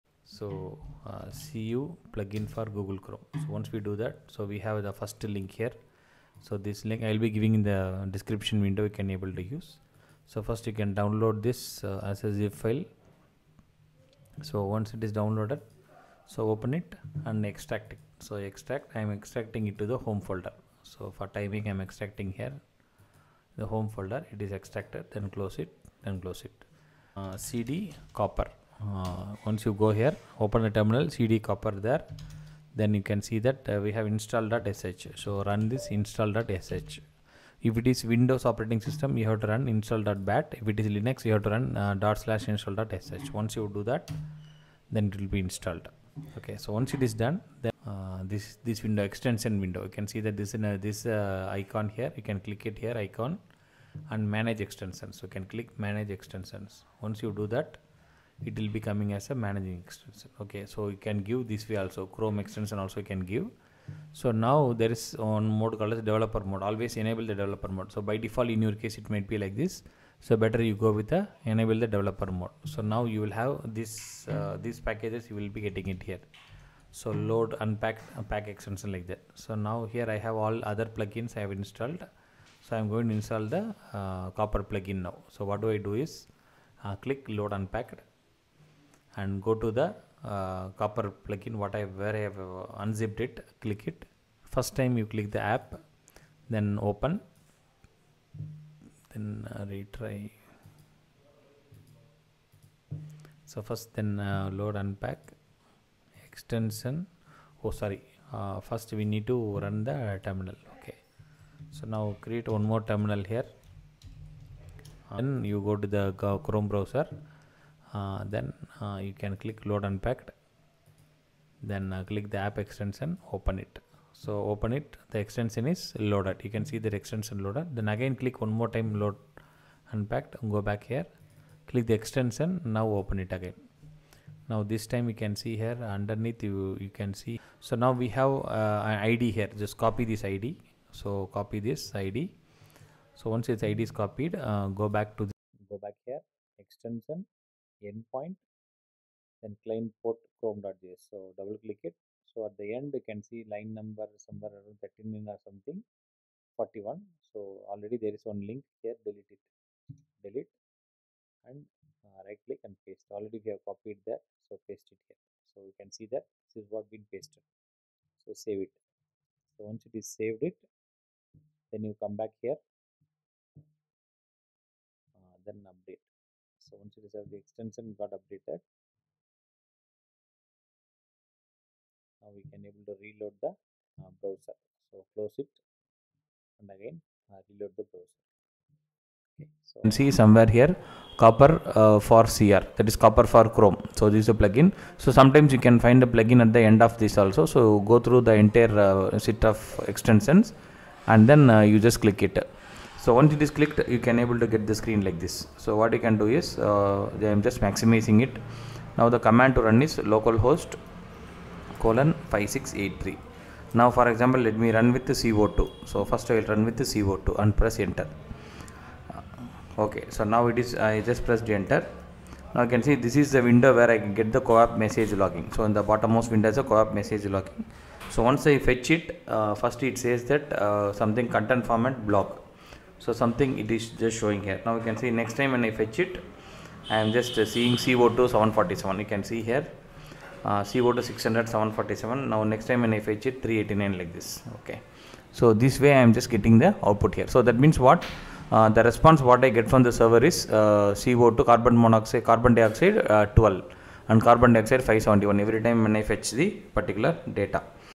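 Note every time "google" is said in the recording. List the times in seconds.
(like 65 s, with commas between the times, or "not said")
2 s.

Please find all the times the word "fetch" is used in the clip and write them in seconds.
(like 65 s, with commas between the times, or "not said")
228 s, 235 s, 243 s, 256 s.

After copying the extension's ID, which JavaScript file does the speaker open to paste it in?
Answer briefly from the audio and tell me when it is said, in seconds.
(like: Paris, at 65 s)
chrome.js, at 150 s.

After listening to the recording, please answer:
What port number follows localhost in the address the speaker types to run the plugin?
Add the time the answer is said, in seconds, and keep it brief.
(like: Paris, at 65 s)
5683, at 212 s.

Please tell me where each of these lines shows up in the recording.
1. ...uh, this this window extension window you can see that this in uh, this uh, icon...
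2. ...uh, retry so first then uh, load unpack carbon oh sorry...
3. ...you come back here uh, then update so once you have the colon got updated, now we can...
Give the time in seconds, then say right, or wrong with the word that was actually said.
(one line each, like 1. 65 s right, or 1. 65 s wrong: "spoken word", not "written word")
1. 47 s right
2. 99 s wrong: "extension", not "carbon"
3. 171 s wrong: "extension", not "colon".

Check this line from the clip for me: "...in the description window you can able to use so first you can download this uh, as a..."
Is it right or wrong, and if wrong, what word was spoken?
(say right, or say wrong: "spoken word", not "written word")
right.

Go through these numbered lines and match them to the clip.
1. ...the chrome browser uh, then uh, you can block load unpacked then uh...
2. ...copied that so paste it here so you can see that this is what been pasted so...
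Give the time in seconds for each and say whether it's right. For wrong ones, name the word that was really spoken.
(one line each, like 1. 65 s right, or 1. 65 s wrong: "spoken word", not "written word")
1. 115 s wrong: "click", not "block"
2. 163 s right.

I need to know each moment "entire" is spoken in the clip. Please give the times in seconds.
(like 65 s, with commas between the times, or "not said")
198 s.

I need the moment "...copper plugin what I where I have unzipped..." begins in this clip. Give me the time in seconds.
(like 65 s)
90 s.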